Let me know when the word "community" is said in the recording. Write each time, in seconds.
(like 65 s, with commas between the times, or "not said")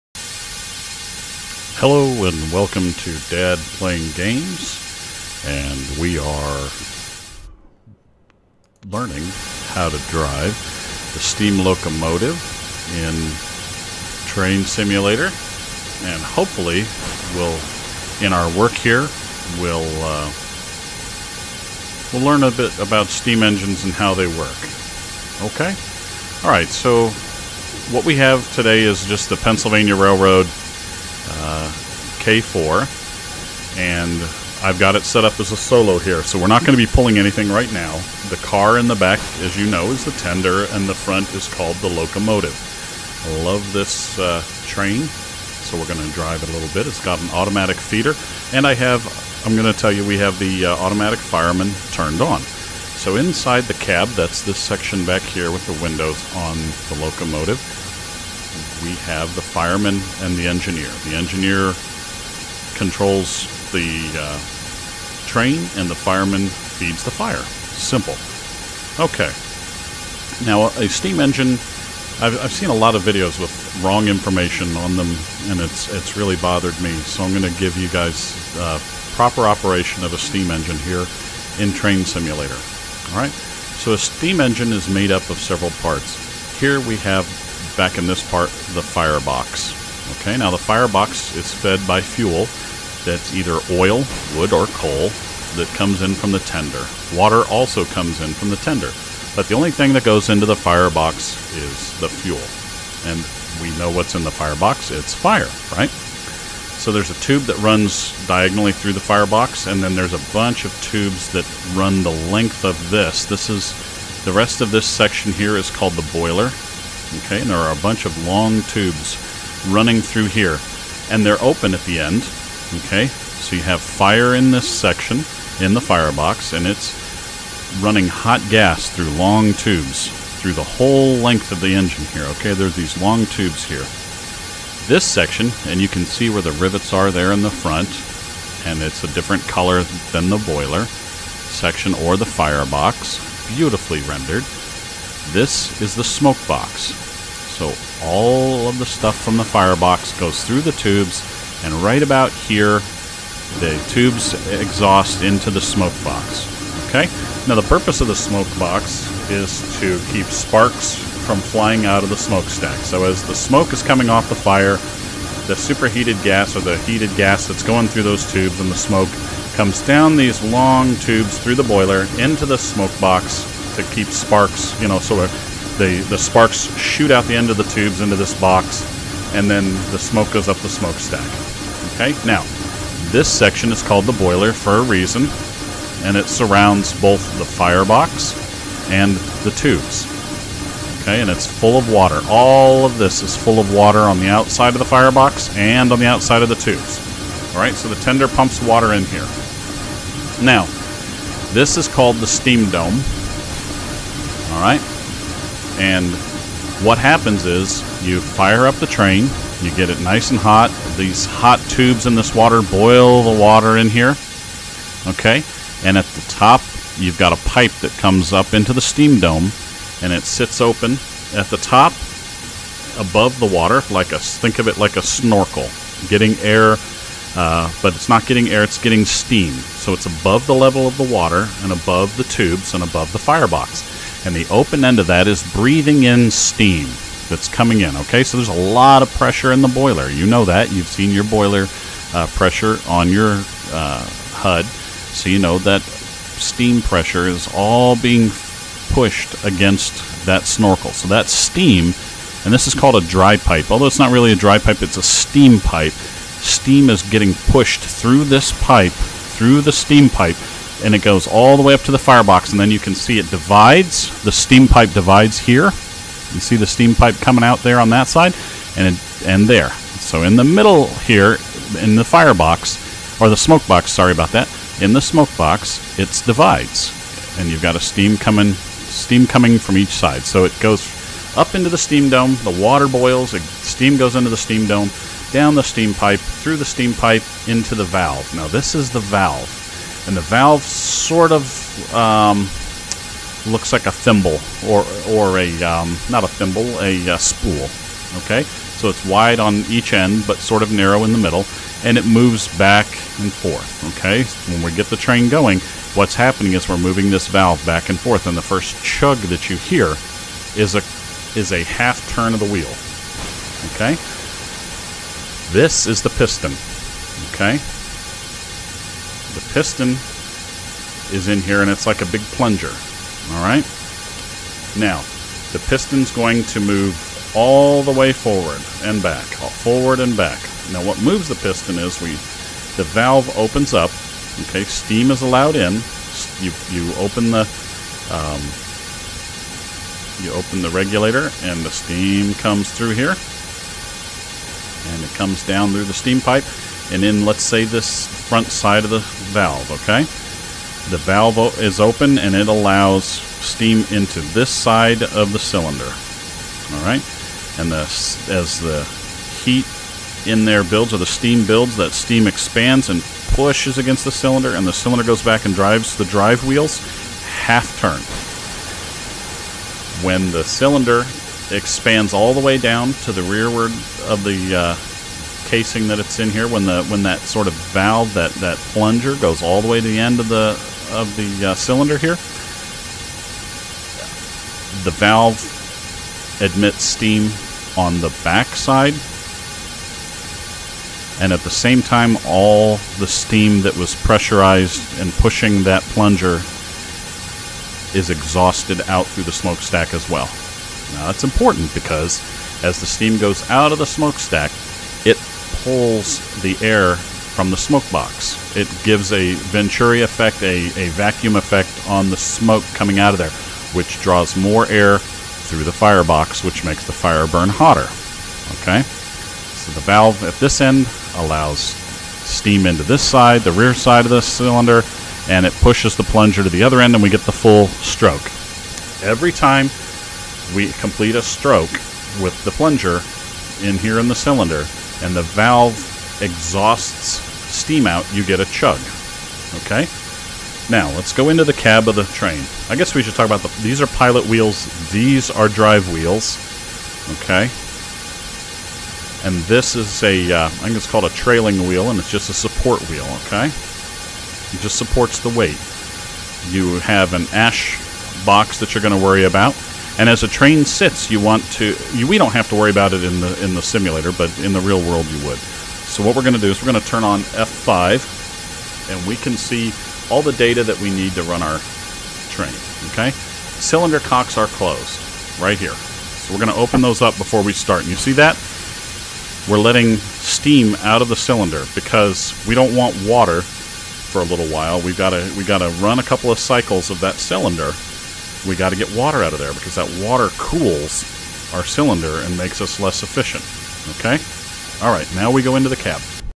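not said.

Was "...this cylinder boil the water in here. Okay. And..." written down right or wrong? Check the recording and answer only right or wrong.
wrong.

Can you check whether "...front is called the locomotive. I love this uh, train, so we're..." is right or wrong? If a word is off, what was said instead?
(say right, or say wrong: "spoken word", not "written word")
right.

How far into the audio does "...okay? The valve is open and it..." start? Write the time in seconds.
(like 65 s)
349 s.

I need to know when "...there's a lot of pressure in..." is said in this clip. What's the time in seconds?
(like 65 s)
238 s.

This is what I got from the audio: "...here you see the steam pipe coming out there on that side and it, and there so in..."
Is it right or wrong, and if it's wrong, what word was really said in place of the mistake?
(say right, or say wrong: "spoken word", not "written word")
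right.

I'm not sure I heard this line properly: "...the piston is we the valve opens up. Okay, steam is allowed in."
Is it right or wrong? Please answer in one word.
right.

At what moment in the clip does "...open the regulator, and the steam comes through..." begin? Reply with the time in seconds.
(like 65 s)
340 s.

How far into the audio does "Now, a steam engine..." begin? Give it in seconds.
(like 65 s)
70 s.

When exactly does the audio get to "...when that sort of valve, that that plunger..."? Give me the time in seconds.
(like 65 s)
376 s.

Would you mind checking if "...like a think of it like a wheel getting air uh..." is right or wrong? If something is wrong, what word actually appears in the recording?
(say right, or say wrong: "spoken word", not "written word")
wrong: "snorkel", not "wheel".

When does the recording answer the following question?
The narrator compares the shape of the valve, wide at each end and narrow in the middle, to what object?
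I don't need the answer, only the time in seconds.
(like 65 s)
297 s.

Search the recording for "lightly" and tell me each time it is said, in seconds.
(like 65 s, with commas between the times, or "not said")
not said.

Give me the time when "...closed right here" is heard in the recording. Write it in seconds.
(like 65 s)
474 s.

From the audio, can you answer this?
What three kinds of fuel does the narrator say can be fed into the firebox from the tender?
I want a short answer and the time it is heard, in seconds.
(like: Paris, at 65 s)
oil, wood, or coal, at 93 s.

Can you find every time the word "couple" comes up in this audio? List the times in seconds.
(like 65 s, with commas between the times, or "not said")
486 s.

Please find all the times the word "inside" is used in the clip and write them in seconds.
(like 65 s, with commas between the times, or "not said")
53 s.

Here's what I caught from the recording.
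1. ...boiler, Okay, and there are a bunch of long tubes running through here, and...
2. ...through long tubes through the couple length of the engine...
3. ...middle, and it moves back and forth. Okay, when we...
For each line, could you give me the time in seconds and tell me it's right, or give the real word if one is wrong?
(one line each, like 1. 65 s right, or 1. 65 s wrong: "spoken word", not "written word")
1. 116 s right
2. 128 s wrong: "whole", not "couple"
3. 301 s right.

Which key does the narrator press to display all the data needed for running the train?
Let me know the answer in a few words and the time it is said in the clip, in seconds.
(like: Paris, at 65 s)
F5, at 467 s.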